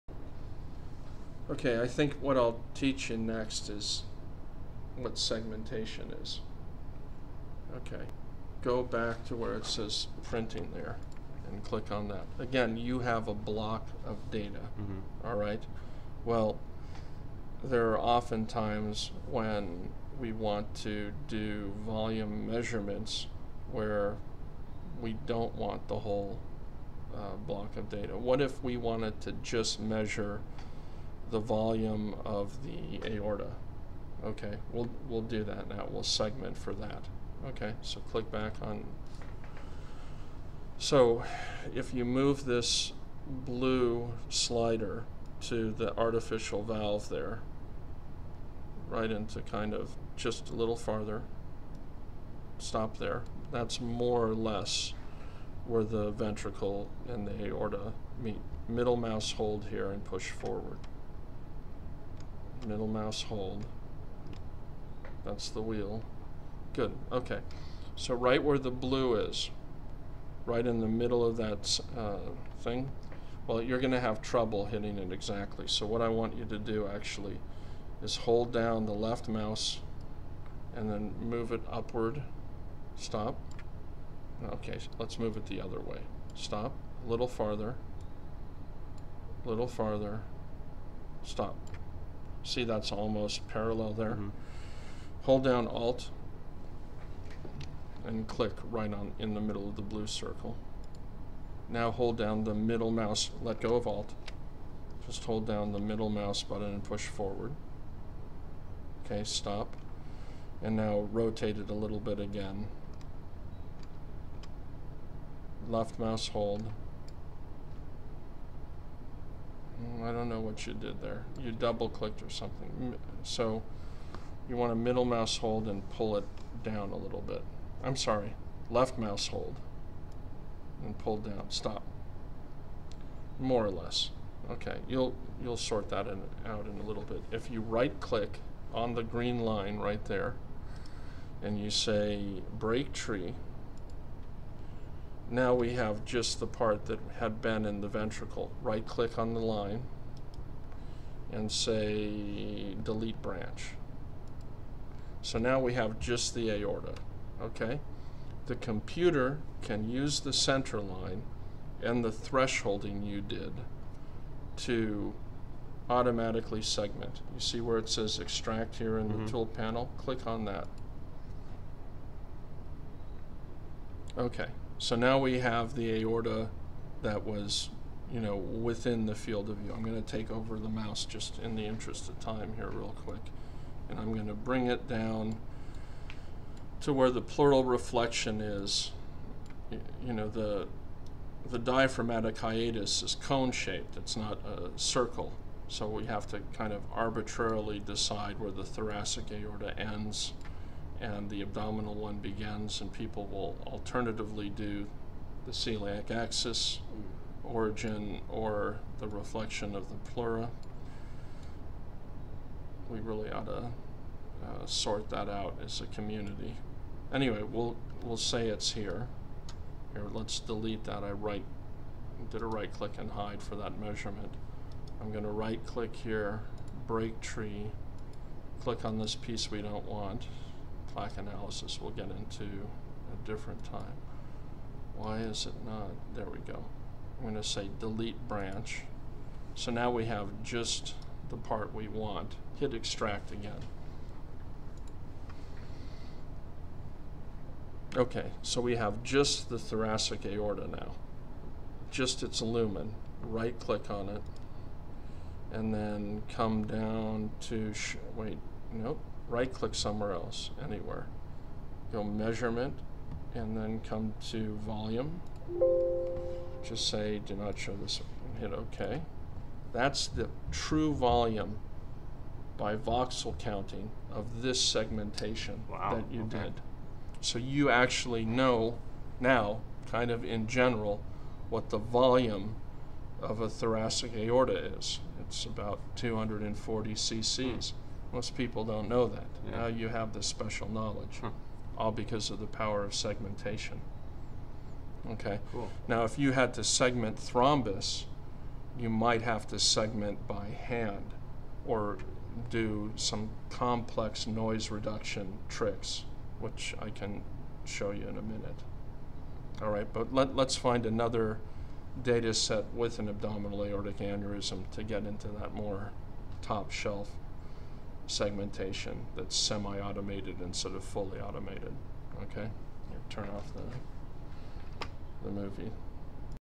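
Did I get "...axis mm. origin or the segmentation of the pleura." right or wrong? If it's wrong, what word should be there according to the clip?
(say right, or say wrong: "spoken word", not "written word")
wrong: "reflection", not "segmentation".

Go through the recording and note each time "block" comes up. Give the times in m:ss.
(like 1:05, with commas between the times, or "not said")
0:13, 0:27.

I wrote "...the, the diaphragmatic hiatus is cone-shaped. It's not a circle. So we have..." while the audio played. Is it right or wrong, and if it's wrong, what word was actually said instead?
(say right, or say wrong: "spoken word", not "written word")
right.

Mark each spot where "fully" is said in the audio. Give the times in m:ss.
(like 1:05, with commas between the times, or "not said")
5:20.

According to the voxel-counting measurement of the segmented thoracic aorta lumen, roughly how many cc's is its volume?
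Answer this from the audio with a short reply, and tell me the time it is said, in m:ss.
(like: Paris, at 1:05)
240, at 4:45.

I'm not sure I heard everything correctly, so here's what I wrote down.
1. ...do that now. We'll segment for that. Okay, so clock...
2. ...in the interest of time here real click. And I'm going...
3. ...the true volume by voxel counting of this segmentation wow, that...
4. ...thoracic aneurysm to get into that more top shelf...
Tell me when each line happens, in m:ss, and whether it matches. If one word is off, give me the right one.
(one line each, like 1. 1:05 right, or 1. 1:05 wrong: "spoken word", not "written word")
1. 0:35 wrong: "click", not "clock"
2. 3:01 wrong: "quick", not "click"
3. 4:30 right
4. 5:13 wrong: "aortic", not "thoracic".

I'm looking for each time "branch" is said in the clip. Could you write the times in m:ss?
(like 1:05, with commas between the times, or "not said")
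2:33, 3:58.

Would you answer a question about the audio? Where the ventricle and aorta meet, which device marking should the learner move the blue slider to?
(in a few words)
artificial valve.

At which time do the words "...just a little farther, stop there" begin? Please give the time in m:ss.
0:50.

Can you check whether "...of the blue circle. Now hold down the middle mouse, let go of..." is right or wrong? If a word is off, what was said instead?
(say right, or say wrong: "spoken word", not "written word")
right.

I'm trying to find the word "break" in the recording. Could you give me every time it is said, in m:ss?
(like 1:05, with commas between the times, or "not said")
2:22, 3:46.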